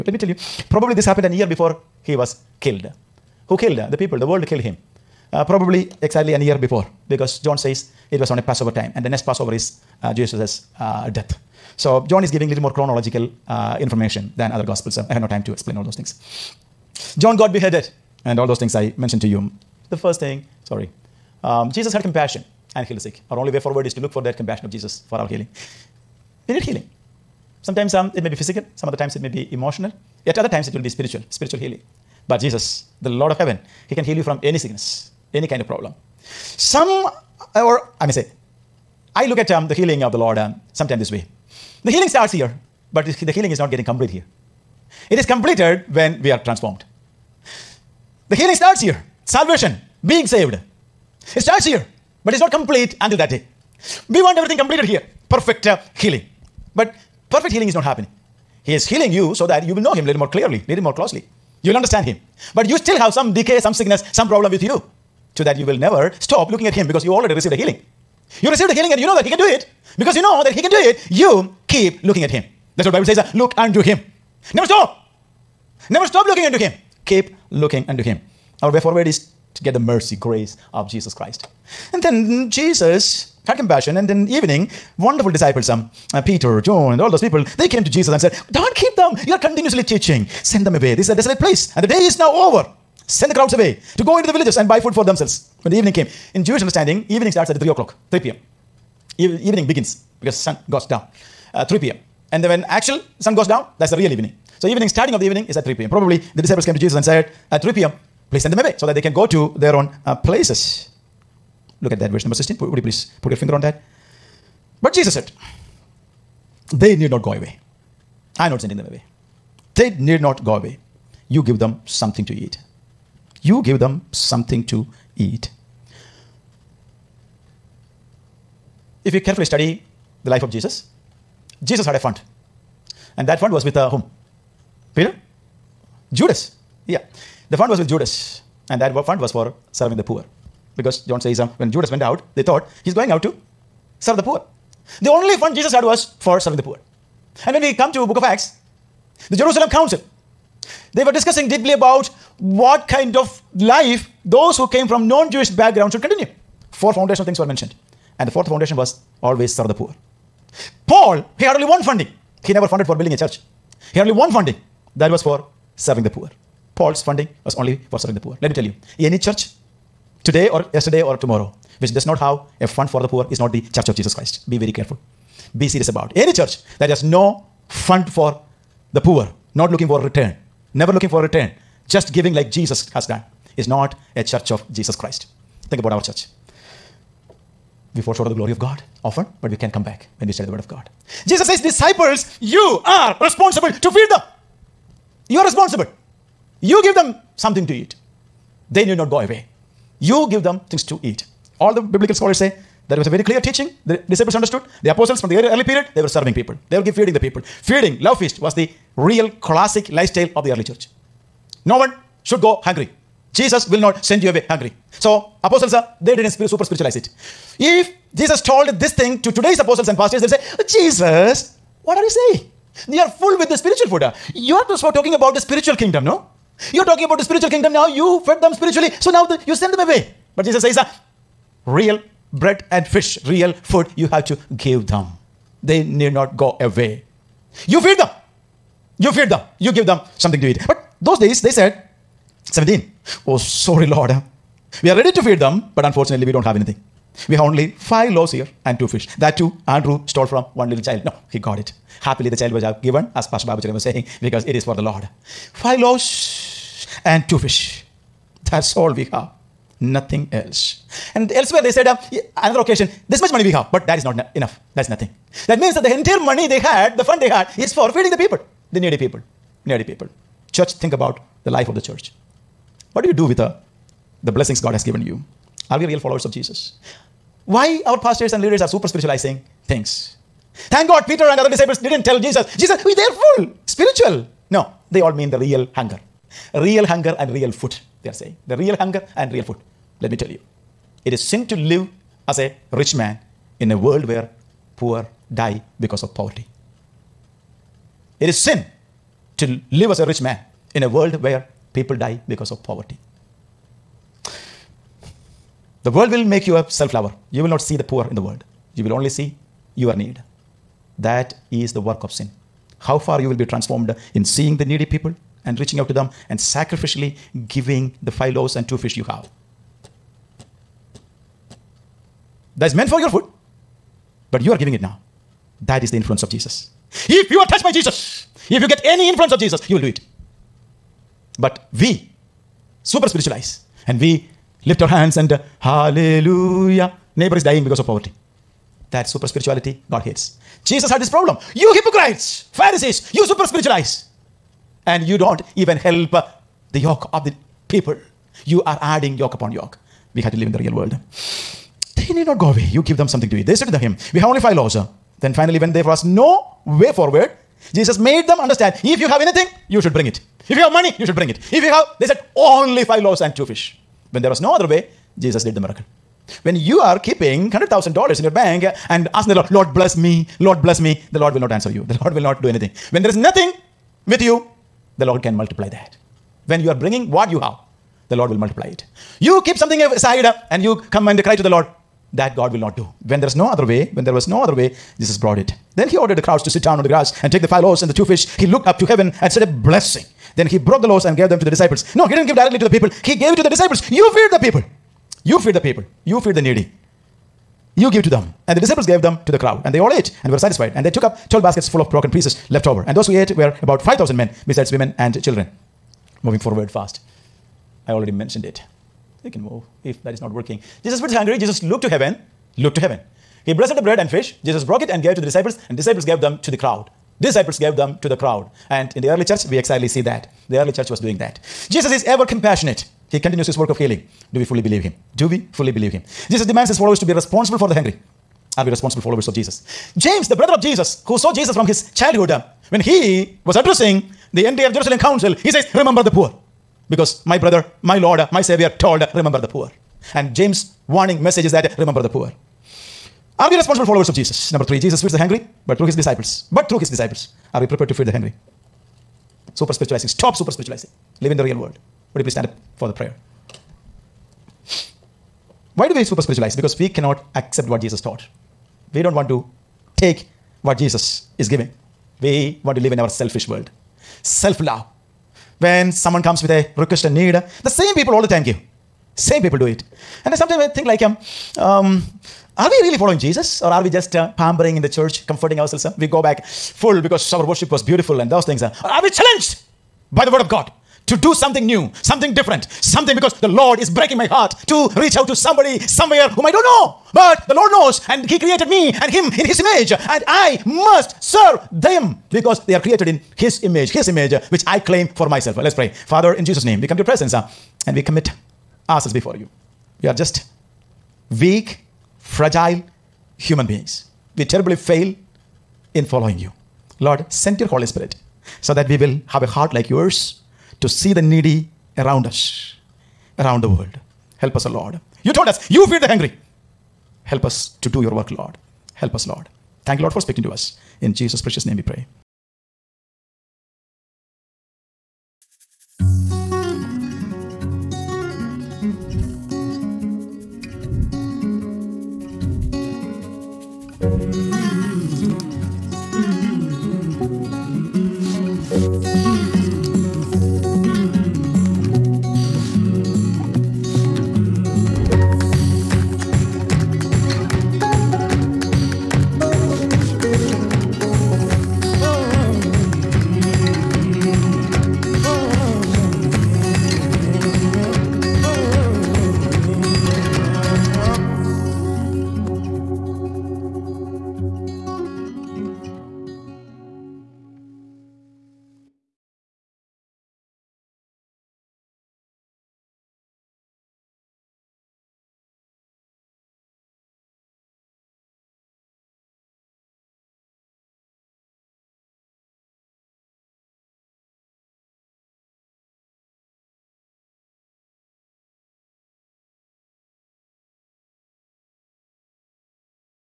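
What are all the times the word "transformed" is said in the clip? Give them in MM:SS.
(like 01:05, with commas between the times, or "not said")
00:46, 05:13.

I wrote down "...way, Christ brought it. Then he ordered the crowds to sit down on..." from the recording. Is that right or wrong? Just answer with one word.
wrong.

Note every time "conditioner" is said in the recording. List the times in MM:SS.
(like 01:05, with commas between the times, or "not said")
not said.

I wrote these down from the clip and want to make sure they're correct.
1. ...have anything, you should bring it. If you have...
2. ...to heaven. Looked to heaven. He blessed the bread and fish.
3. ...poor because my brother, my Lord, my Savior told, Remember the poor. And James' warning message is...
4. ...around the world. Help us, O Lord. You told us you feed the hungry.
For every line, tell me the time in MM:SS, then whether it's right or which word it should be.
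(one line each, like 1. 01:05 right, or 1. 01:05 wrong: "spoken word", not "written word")
1. 05:59 right
2. 06:51 right
3. 07:16 right
4. 08:33 right.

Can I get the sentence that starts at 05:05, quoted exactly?
The world will make you a self lover.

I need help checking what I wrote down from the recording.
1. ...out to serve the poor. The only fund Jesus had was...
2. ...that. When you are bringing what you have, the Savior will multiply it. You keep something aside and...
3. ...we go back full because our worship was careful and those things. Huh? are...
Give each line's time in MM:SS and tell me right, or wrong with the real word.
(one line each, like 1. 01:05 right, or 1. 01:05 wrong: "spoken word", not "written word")
1. 02:23 right
2. 06:15 wrong: "Lord", not "Savior"
3. 07:55 wrong: "beautiful", not "careful".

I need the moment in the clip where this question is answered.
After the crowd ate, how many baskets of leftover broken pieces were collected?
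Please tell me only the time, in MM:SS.
06:41.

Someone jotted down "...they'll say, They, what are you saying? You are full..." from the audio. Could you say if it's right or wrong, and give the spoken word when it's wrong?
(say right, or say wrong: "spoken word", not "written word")
wrong: "Jesus", not "They".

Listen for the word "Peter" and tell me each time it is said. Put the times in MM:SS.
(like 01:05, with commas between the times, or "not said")
01:26, 02:14, 04:41.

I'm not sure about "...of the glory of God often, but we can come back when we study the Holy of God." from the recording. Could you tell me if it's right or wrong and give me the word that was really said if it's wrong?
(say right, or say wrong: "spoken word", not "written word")
wrong: "Word", not "Holy".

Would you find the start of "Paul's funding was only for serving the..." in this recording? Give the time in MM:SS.
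02:46.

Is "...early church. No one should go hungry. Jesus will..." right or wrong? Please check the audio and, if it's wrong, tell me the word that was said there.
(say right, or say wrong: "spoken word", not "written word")
right.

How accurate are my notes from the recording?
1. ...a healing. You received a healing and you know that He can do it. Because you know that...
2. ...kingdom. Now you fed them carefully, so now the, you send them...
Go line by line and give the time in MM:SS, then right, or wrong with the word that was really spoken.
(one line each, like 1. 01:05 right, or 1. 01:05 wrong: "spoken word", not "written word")
1. 01:07 right
2. 03:47 wrong: "spiritually", not "carefully".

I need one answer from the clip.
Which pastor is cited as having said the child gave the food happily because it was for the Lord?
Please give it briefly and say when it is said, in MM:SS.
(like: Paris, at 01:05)
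Pastor Babu, at 04:13.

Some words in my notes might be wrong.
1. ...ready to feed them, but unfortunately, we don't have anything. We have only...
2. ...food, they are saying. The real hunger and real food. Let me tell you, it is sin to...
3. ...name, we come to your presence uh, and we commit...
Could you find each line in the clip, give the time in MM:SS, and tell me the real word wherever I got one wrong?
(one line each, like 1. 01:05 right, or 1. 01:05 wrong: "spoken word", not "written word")
1. 04:04 right
2. 04:47 right
3. 08:16 right.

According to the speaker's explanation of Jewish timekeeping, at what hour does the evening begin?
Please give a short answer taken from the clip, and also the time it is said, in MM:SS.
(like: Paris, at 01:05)
3 p.m., at 01:37.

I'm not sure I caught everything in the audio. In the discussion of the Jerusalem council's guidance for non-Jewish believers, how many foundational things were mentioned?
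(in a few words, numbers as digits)
4.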